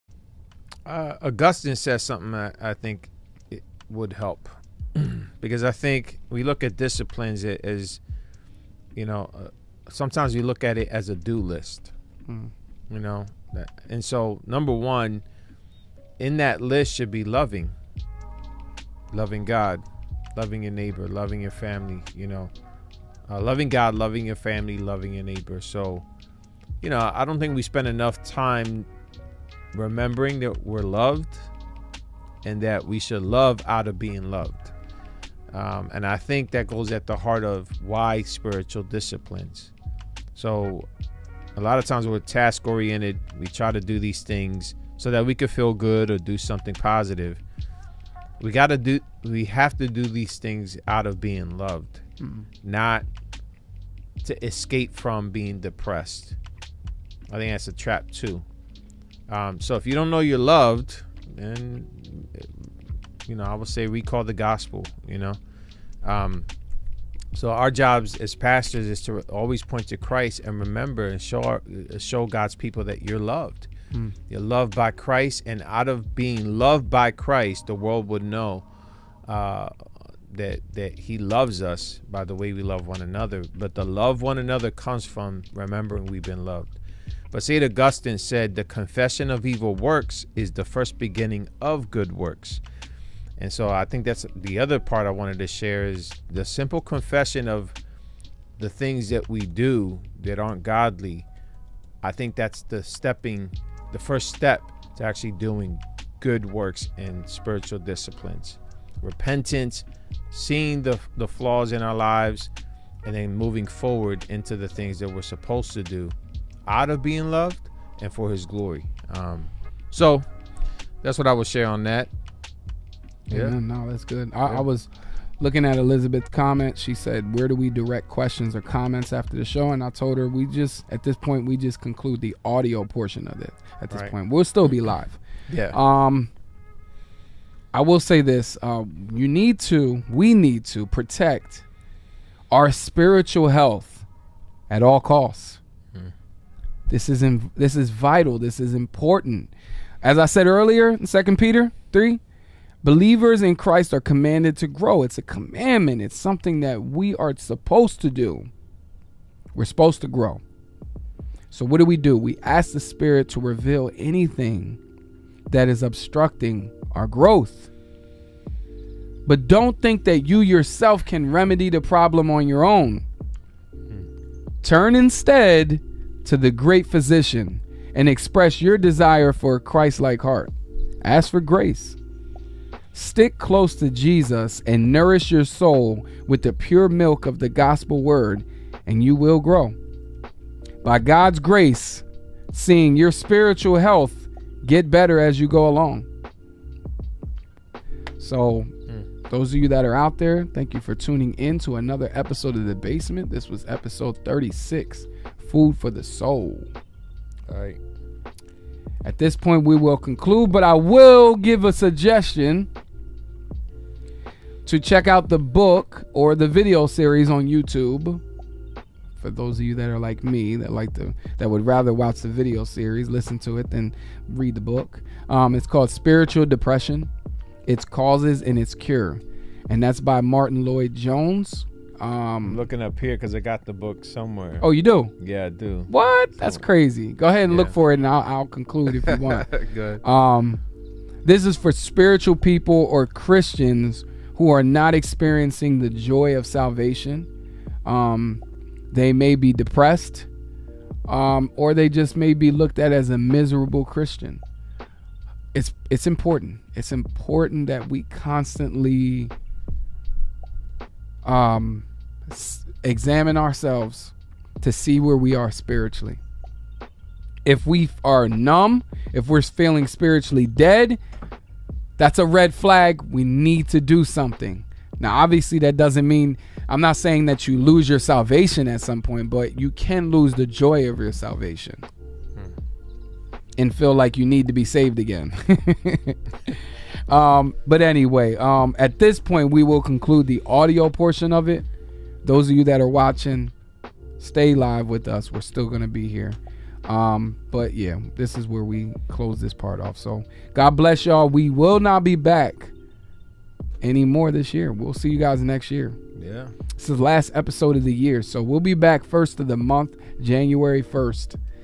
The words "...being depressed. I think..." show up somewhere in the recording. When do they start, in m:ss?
0:55.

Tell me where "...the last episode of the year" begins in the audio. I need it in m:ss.
5:06.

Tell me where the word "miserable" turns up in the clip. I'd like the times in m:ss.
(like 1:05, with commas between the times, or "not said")
4:13.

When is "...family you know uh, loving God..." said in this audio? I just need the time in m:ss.
0:21.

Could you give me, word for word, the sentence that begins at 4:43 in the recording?
and feel like you need to be saved again.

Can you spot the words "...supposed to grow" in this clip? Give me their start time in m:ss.
2:39.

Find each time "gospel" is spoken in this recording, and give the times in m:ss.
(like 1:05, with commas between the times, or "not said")
1:04, 3:07.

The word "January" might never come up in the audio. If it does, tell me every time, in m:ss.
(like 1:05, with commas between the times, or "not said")
5:10.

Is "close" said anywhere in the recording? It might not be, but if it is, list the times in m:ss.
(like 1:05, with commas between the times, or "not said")
3:03, 4:59.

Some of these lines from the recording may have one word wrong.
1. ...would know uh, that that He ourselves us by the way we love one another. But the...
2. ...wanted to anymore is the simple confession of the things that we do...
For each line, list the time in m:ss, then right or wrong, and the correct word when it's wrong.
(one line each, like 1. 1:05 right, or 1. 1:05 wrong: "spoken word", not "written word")
1. 1:18 wrong: "loves", not "ourselves"
2. 1:35 wrong: "share", not "anymore".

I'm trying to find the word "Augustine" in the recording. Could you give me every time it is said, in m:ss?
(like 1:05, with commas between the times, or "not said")
0:01, 1:27.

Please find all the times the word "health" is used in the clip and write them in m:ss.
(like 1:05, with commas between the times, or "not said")
2:23, 3:13.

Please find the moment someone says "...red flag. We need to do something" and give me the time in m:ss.
4:32.